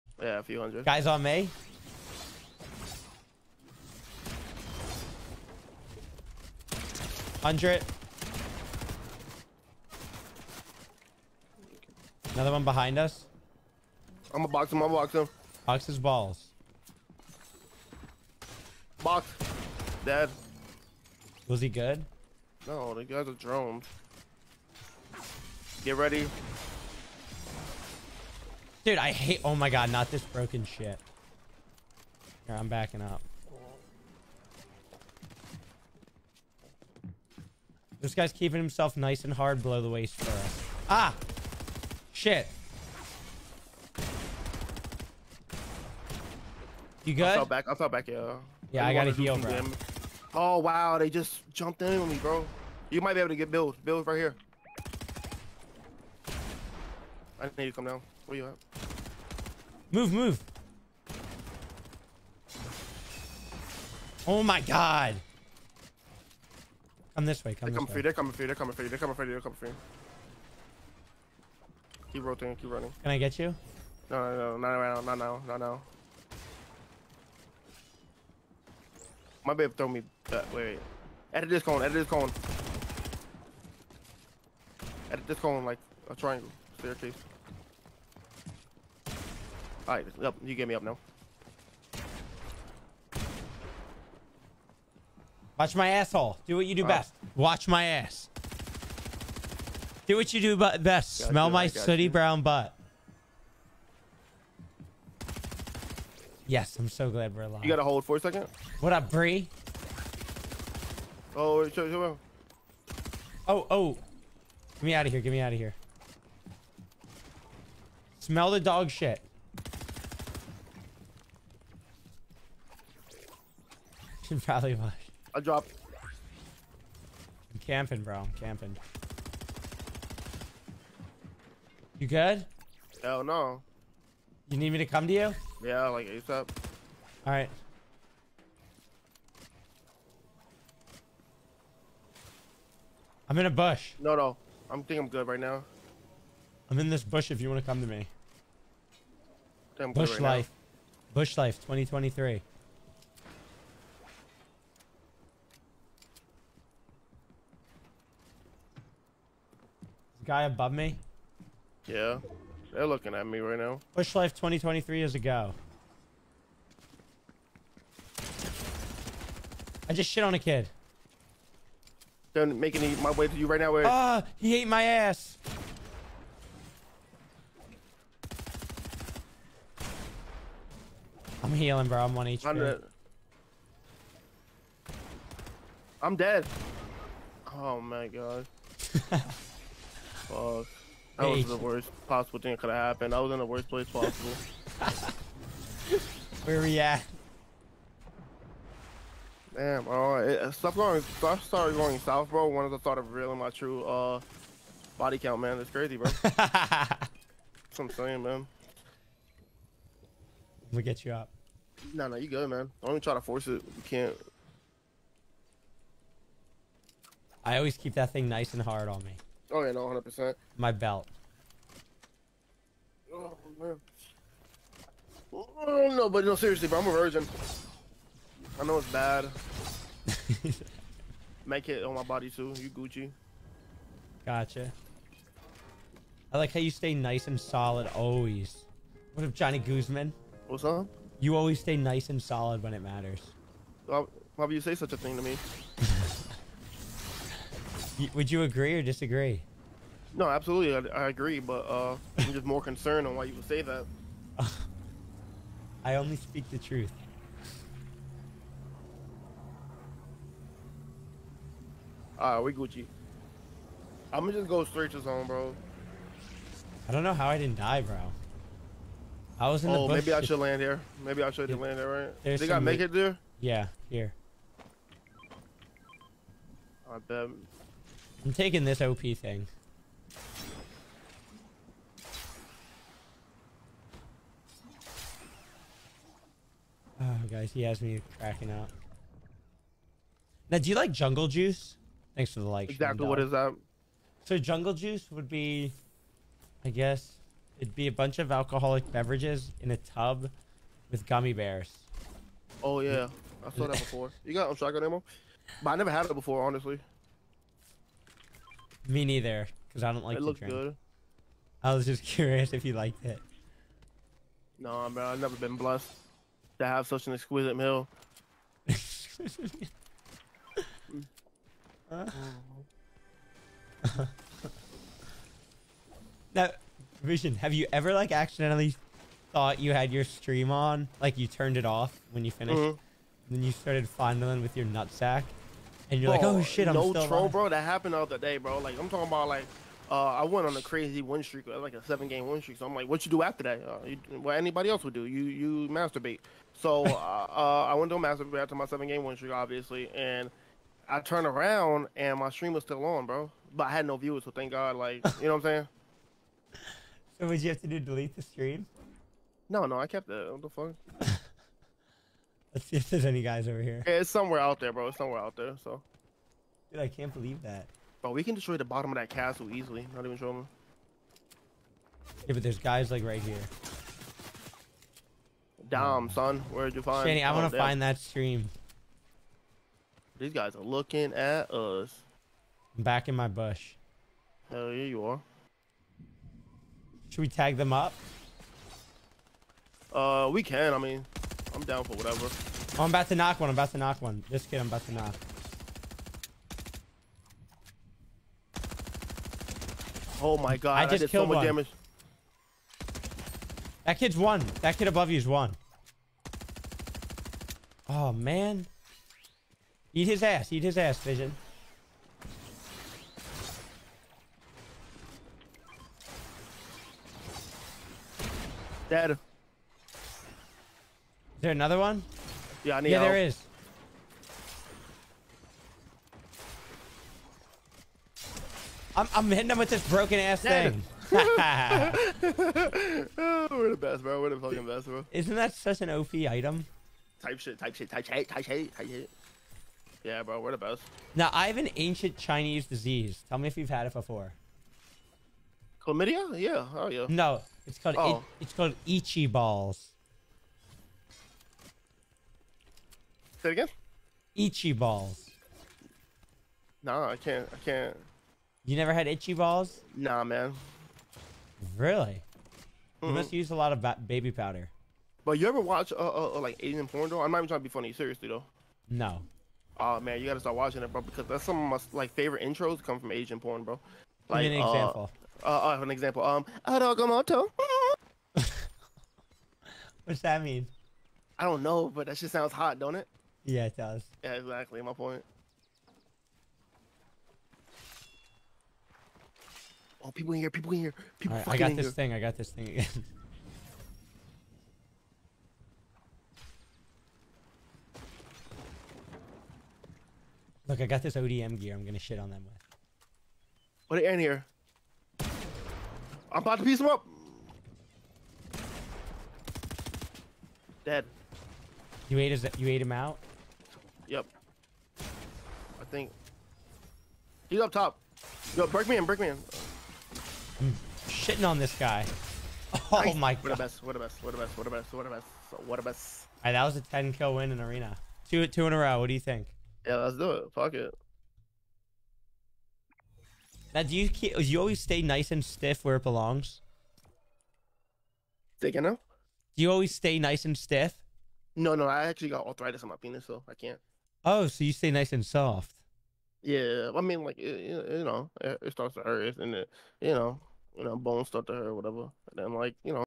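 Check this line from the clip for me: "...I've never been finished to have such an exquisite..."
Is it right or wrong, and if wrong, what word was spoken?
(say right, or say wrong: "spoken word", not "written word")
wrong: "blessed", not "finished".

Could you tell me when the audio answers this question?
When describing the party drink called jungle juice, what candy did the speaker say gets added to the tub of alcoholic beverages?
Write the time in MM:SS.
05:01.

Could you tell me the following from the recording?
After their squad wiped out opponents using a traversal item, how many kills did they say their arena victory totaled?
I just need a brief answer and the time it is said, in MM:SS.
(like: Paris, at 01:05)
10, at 08:46.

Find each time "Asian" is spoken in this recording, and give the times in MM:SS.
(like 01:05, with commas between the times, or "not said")
07:46, 07:53.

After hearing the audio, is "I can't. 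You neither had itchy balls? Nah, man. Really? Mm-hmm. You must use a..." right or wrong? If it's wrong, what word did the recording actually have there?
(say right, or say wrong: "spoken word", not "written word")
wrong: "never", not "neither".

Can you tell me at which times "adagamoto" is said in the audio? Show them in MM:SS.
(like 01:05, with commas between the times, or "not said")
07:56.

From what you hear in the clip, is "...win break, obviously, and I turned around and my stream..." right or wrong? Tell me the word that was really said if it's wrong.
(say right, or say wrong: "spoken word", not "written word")
wrong: "streak", not "break".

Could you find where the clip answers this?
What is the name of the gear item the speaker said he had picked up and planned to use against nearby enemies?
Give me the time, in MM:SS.
08:21.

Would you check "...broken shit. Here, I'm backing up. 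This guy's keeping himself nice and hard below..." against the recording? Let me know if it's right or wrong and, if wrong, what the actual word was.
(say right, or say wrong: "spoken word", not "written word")
right.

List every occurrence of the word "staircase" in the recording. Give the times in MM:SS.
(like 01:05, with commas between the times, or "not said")
01:26.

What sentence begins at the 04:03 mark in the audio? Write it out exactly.
Why, why would you say such a thing to me?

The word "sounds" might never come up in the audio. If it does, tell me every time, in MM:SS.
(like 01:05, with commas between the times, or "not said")
08:02.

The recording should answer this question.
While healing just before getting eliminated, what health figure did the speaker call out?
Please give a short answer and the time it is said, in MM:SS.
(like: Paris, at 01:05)
100, at 03:02.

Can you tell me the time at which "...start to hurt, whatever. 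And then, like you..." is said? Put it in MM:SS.
09:11.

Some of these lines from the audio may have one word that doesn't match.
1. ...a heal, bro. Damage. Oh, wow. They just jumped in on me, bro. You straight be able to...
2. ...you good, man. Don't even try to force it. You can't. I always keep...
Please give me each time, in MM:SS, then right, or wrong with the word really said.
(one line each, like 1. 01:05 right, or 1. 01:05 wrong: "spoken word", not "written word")
1. 00:49 wrong: "might", not "straight"
2. 03:32 right.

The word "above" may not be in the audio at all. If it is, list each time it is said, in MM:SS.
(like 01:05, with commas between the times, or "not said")
02:40, 06:44.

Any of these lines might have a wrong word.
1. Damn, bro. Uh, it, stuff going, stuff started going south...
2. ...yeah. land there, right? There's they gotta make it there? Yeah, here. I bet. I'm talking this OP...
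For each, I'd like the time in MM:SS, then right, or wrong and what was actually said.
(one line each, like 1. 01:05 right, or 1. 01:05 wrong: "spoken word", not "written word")
1. 03:19 right
2. 04:31 wrong: "taking", not "talking".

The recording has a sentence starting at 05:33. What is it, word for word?
then you started fondling with your nutsack?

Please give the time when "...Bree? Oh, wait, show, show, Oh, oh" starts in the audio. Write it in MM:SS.
01:49.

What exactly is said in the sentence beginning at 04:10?
No, absolutely, I, I agree, but uh, I'm just more concerned on why you would say that.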